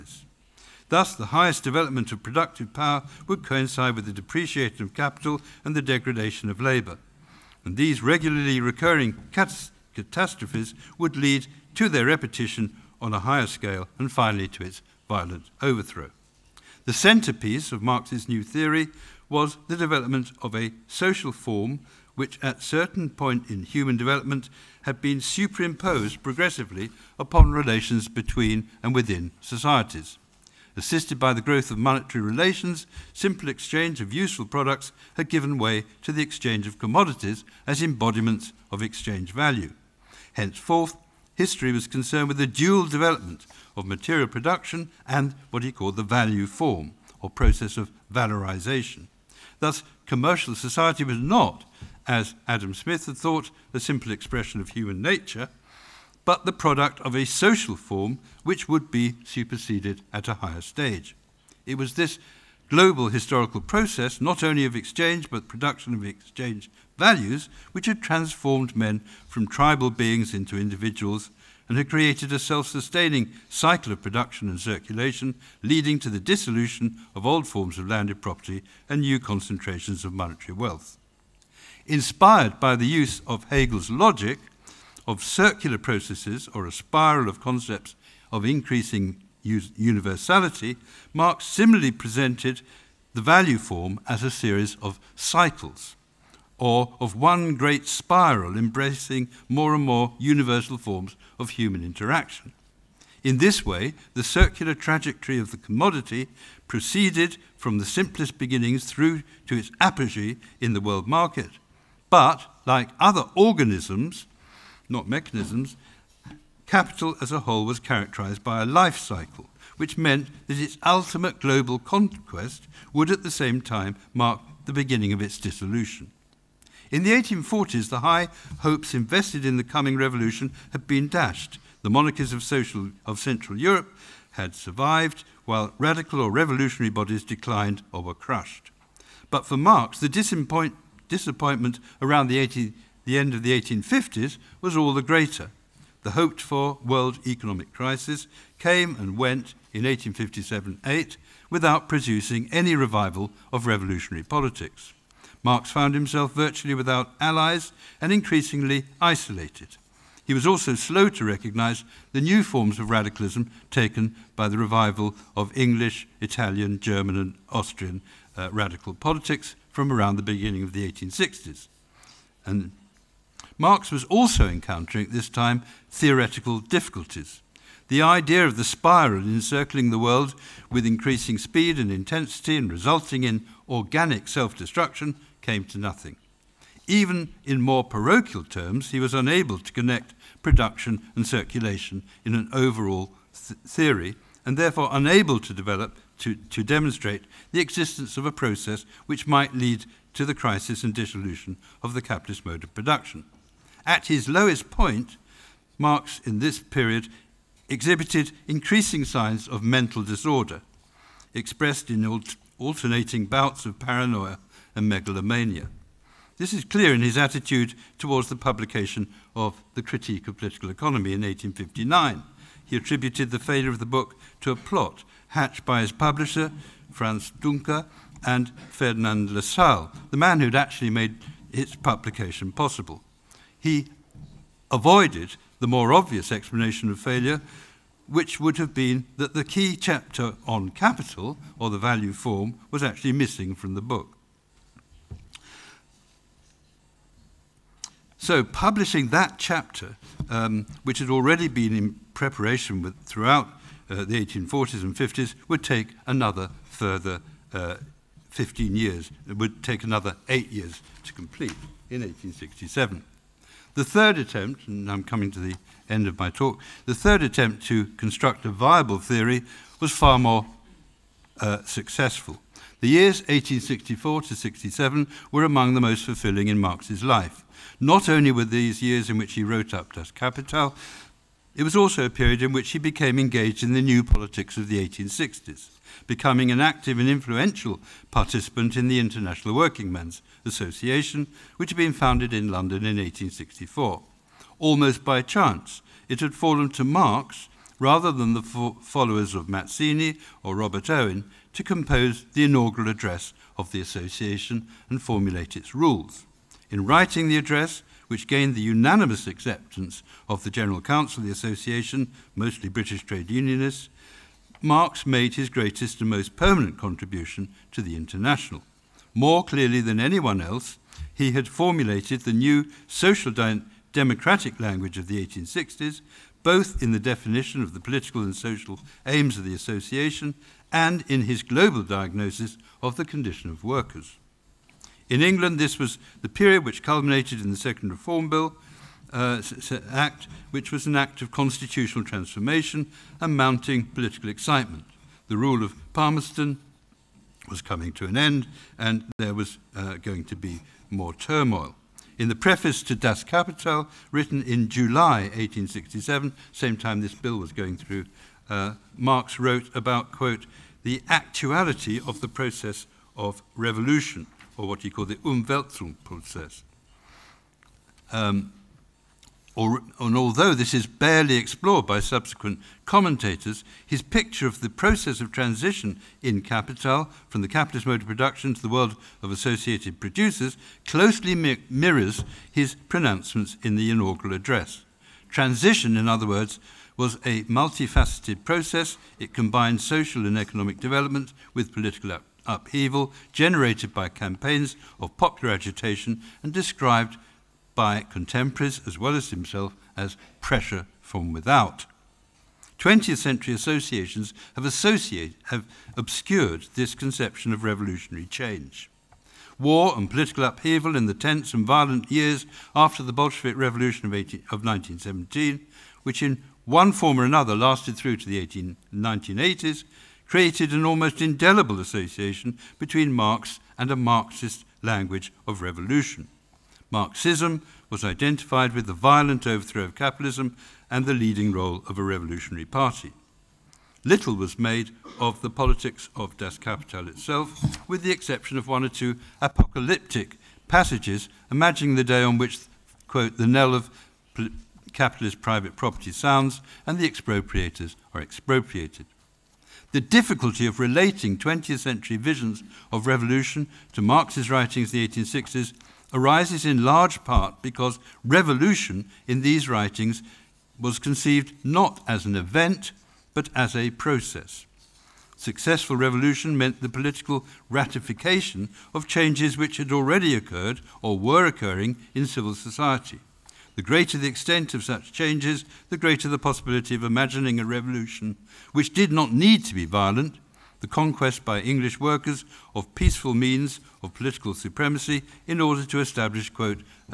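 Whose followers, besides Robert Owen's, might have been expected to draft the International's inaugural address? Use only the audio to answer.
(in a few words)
Mazzini.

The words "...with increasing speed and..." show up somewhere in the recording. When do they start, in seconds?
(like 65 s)
180 s.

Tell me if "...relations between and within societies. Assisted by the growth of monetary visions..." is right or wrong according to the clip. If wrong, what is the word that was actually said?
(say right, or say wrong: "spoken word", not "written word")
wrong: "relations", not "visions".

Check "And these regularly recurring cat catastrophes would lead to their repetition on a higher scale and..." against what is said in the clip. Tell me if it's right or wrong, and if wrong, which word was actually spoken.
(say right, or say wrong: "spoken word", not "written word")
right.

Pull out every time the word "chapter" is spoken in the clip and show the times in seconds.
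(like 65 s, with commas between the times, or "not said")
239 s, 249 s.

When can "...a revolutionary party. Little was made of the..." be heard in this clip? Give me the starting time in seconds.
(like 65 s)
431 s.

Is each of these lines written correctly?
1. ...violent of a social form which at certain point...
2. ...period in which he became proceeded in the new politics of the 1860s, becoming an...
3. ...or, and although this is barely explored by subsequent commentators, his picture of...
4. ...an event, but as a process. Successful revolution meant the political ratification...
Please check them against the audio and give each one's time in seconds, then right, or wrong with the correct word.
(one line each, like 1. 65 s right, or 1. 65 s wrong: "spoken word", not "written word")
1. 19 s wrong: "development", not "violent"
2. 282 s wrong: "engaged", not "proceeded"
3. 369 s right
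4. 462 s right.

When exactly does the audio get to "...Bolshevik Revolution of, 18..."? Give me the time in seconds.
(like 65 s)
413 s.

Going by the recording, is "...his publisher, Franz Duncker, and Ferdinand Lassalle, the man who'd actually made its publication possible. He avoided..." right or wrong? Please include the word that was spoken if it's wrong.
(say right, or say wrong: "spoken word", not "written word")
right.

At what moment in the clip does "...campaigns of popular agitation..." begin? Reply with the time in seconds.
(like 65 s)
394 s.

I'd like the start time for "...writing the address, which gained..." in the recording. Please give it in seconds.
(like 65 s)
306 s.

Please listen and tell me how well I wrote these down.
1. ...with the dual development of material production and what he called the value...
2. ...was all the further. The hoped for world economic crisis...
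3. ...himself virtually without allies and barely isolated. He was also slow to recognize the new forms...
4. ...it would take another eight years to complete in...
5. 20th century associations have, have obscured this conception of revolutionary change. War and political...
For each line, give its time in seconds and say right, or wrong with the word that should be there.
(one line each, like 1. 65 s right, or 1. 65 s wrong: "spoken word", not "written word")
1. 42 s right
2. 144 s wrong: "greater", not "further"
3. 155 s wrong: "increasingly", not "barely"
4. 259 s right
5. 402 s right.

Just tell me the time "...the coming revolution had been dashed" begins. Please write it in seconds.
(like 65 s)
129 s.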